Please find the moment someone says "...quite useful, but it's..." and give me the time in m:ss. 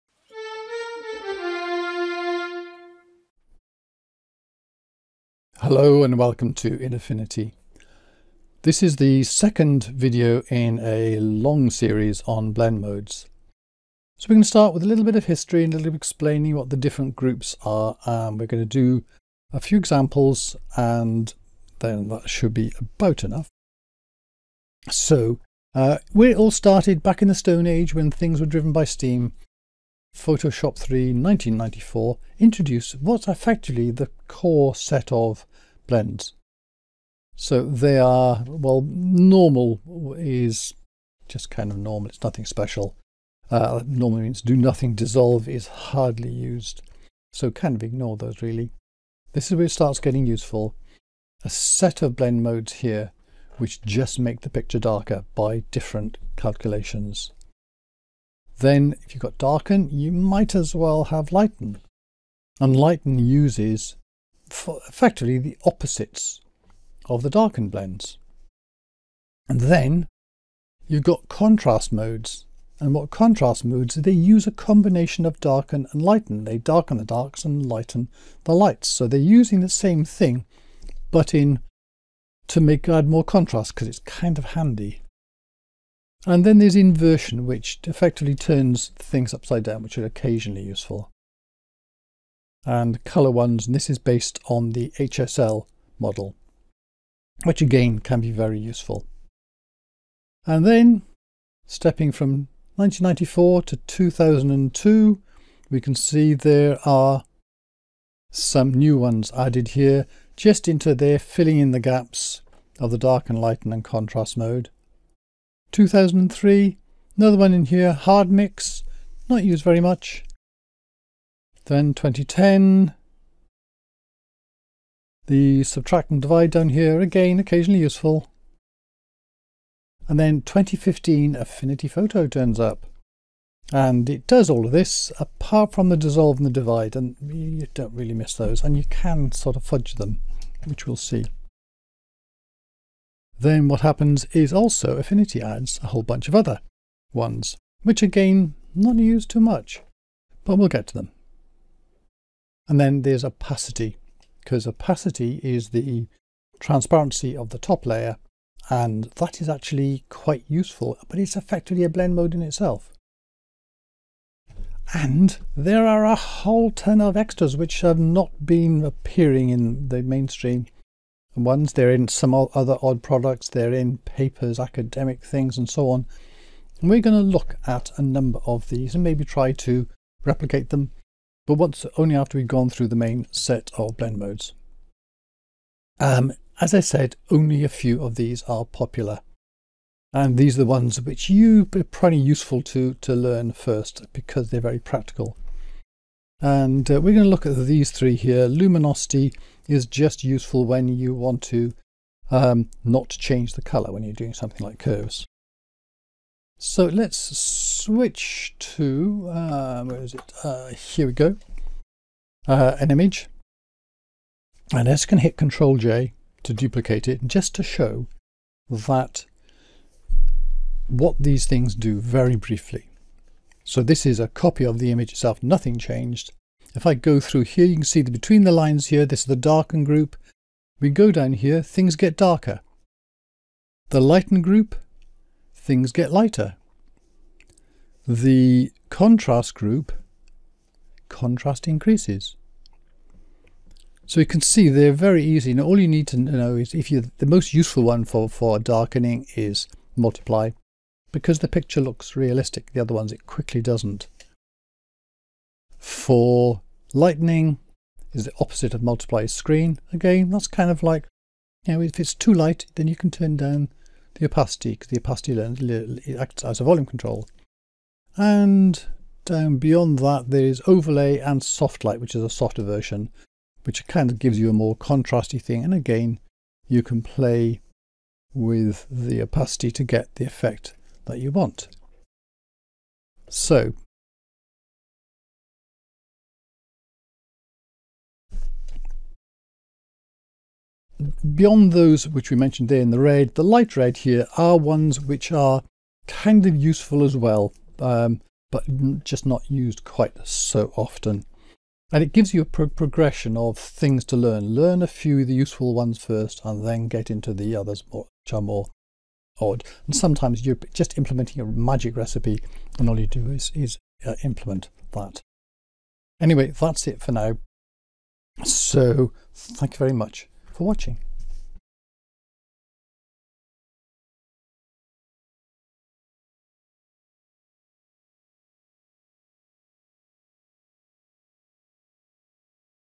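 2:40.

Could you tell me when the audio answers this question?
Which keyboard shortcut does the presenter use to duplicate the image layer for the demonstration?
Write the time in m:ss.
3:35.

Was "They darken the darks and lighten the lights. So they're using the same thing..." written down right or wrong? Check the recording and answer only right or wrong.
right.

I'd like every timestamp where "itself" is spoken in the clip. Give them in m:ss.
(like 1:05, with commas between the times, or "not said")
2:42, 3:45.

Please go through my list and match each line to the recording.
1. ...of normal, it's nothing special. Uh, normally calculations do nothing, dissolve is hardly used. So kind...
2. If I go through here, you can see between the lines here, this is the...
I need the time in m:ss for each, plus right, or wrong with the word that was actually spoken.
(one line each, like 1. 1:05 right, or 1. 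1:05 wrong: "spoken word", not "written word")
1. 0:41 wrong: "means", not "calculations"
2. 3:46 right.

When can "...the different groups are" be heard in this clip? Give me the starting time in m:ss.
0:16.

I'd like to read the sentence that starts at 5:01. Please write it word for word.
And it gives you a pro progression of things to learn.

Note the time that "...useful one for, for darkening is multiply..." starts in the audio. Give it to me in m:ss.
4:07.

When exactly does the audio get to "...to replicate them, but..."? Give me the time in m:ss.
2:59.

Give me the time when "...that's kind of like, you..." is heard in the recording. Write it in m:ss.
4:20.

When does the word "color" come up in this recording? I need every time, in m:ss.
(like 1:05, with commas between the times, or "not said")
1:33, 3:23.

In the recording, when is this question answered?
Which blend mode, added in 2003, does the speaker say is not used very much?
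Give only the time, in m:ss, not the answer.
1:57.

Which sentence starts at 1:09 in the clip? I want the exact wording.
And then you've got contrast modes.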